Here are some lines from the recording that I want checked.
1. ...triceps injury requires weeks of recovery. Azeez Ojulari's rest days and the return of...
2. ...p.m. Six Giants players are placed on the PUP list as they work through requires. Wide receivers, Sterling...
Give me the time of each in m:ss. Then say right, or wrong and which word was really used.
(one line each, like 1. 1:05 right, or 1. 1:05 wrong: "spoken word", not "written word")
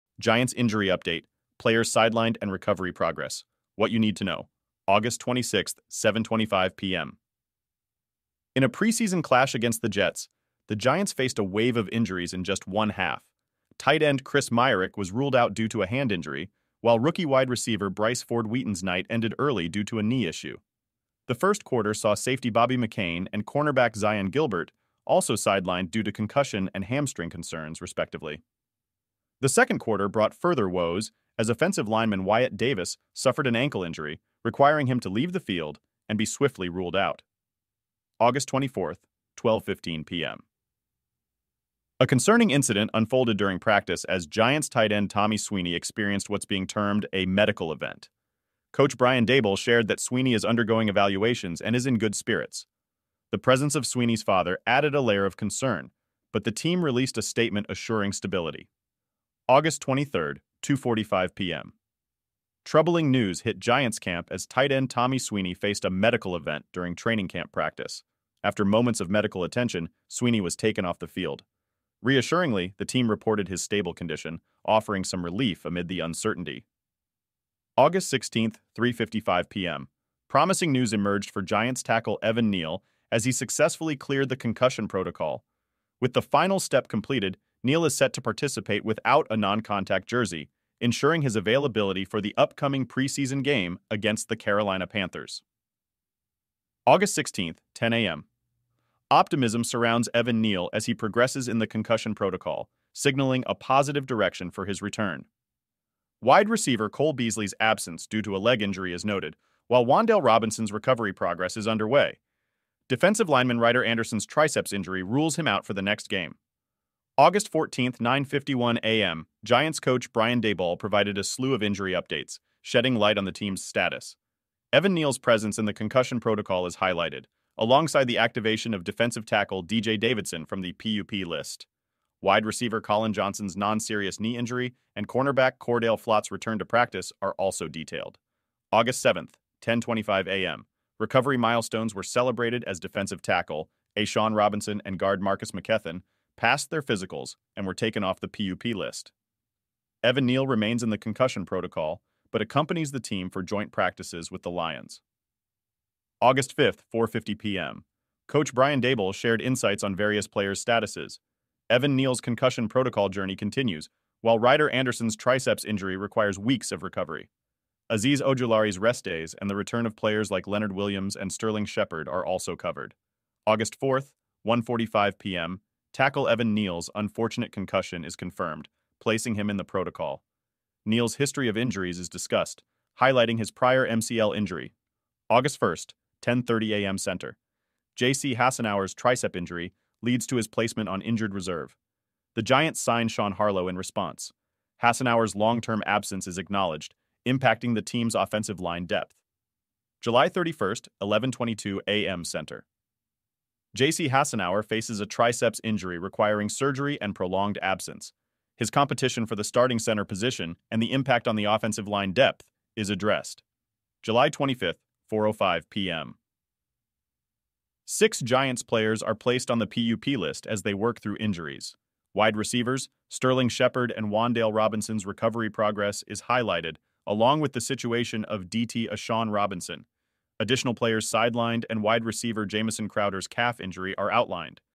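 1. 2:45 right
2. 3:35 wrong: "injuries", not "requires".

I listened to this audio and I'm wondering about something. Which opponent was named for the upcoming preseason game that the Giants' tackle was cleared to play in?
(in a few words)
Carolina Panthers.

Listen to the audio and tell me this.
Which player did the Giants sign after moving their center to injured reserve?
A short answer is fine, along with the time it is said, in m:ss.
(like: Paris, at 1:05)
Sean Harlow, at 3:13.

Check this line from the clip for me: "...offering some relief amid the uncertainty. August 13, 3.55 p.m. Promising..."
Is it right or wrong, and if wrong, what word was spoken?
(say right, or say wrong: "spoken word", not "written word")
wrong: "16", not "13".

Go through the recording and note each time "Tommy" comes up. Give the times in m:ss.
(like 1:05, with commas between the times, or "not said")
0:45, 1:04.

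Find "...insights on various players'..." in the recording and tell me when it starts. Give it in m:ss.
2:39.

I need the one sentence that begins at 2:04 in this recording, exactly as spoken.
Evan Neal's presence in the concussion protocol is highlighted, alongside the activation of defensive tackle DJ Davidson from the PUP list.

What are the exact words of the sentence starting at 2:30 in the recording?
Evan Neal remains in the concussion protocol, but accompanies the team for joint practices with the Lions.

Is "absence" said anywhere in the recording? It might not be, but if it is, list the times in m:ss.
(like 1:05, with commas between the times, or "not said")
1:47, 3:15, 3:27.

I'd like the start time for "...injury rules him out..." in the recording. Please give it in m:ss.
1:54.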